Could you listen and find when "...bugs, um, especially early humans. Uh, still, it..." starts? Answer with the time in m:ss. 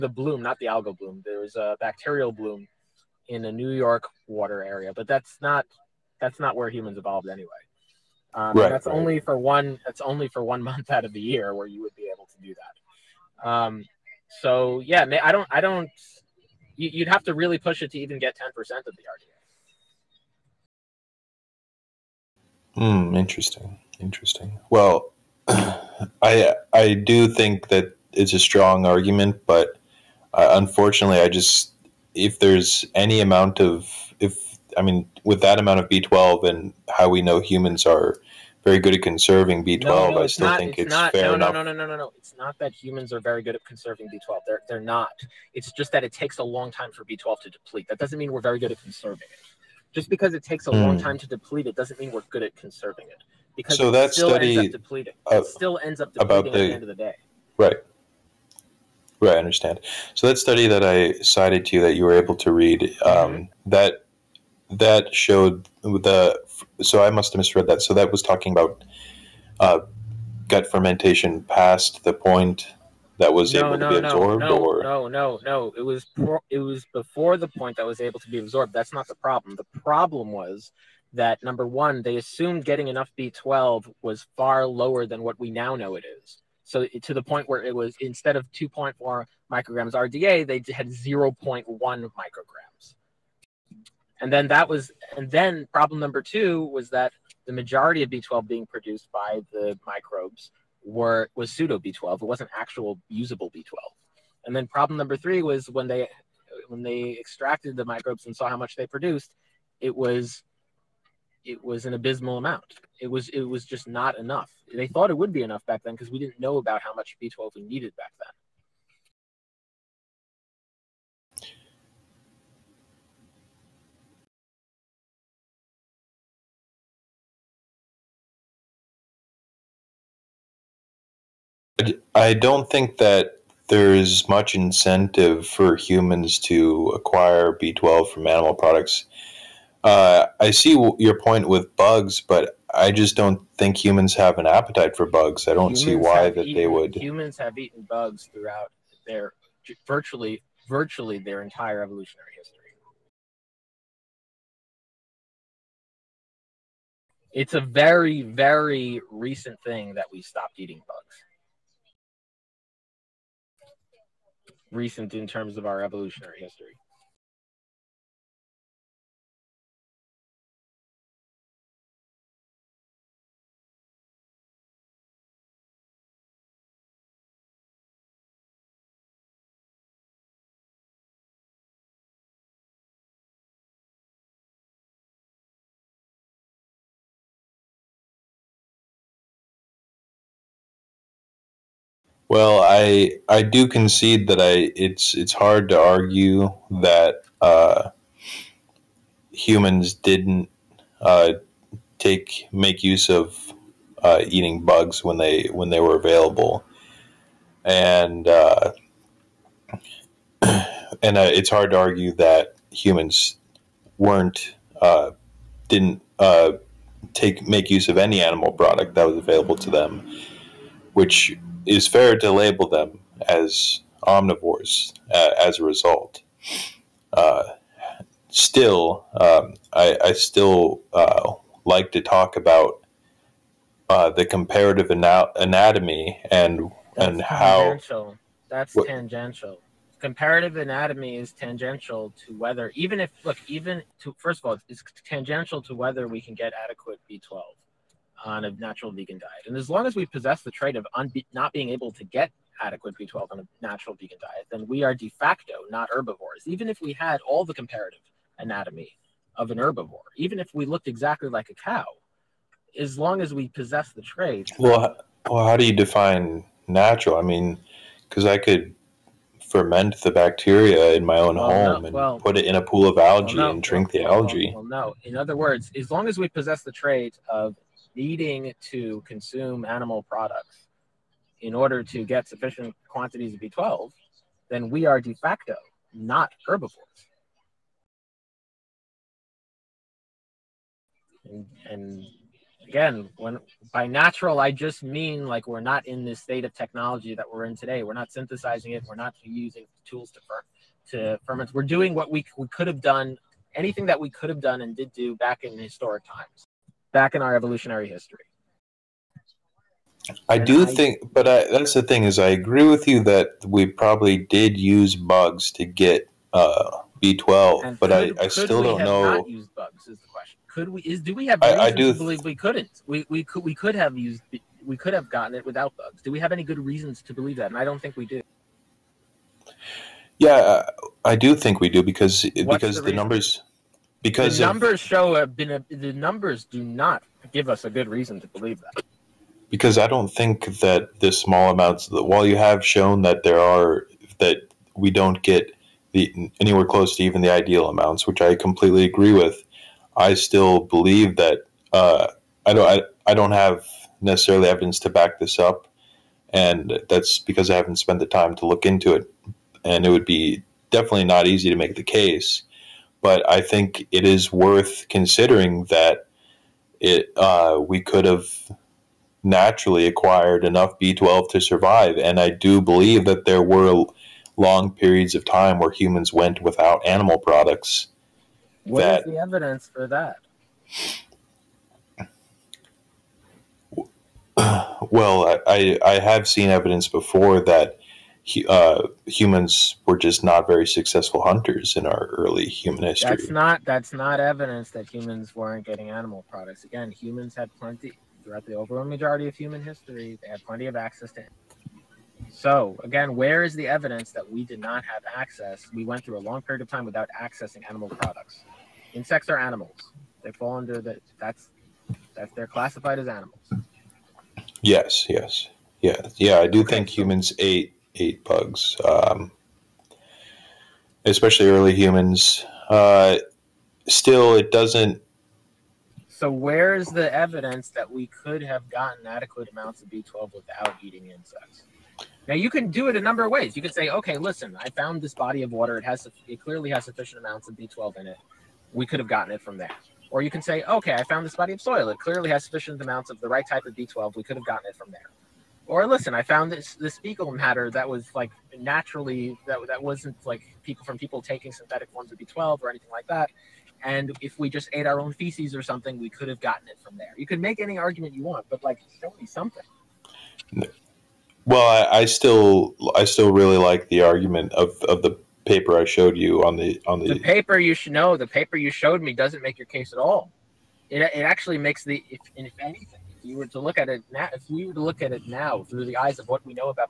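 6:58.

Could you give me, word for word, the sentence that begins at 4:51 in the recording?
And, and, again, when by natural I just mean like we're not in this state of technology that we're in today.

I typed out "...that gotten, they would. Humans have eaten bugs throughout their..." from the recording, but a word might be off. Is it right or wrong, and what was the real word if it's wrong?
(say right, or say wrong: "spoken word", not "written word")
wrong: "eaten", not "gotten".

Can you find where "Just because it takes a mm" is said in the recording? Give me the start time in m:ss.
0:49.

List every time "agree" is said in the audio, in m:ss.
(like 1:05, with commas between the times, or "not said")
5:12, 5:48.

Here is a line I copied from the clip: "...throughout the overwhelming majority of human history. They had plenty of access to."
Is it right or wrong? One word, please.
right.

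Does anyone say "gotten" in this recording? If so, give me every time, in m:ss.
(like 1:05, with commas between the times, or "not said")
5:25, 7:08, 7:19, 7:24, 7:36.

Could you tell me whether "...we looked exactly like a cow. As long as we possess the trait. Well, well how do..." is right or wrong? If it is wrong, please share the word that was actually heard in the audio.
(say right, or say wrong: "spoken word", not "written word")
right.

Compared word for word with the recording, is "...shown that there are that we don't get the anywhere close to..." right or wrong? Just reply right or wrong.
right.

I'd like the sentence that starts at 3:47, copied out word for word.
Uh, still, um, I, I, still uh, like to talk about uh, the comparative ana- anatomy and That's and tangential.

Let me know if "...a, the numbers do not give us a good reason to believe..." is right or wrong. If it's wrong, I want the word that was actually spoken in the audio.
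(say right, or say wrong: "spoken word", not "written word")
right.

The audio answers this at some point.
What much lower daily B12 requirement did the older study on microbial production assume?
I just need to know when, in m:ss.
1:30.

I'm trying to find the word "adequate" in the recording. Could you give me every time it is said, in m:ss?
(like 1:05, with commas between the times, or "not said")
4:06, 4:12, 7:09.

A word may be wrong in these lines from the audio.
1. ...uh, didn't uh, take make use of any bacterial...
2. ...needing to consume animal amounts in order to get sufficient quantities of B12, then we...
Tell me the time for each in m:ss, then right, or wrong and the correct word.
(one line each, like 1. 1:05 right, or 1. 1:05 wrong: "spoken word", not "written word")
1. 3:34 wrong: "animal", not "bacterial"
2. 4:37 wrong: "products", not "amounts".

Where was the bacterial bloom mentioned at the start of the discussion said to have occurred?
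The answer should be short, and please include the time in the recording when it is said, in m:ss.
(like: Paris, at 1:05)
New York, at 0:03.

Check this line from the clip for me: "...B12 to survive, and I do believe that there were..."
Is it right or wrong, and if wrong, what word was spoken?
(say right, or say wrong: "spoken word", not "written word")
right.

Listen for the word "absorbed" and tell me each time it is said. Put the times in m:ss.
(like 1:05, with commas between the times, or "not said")
1:14, 1:18.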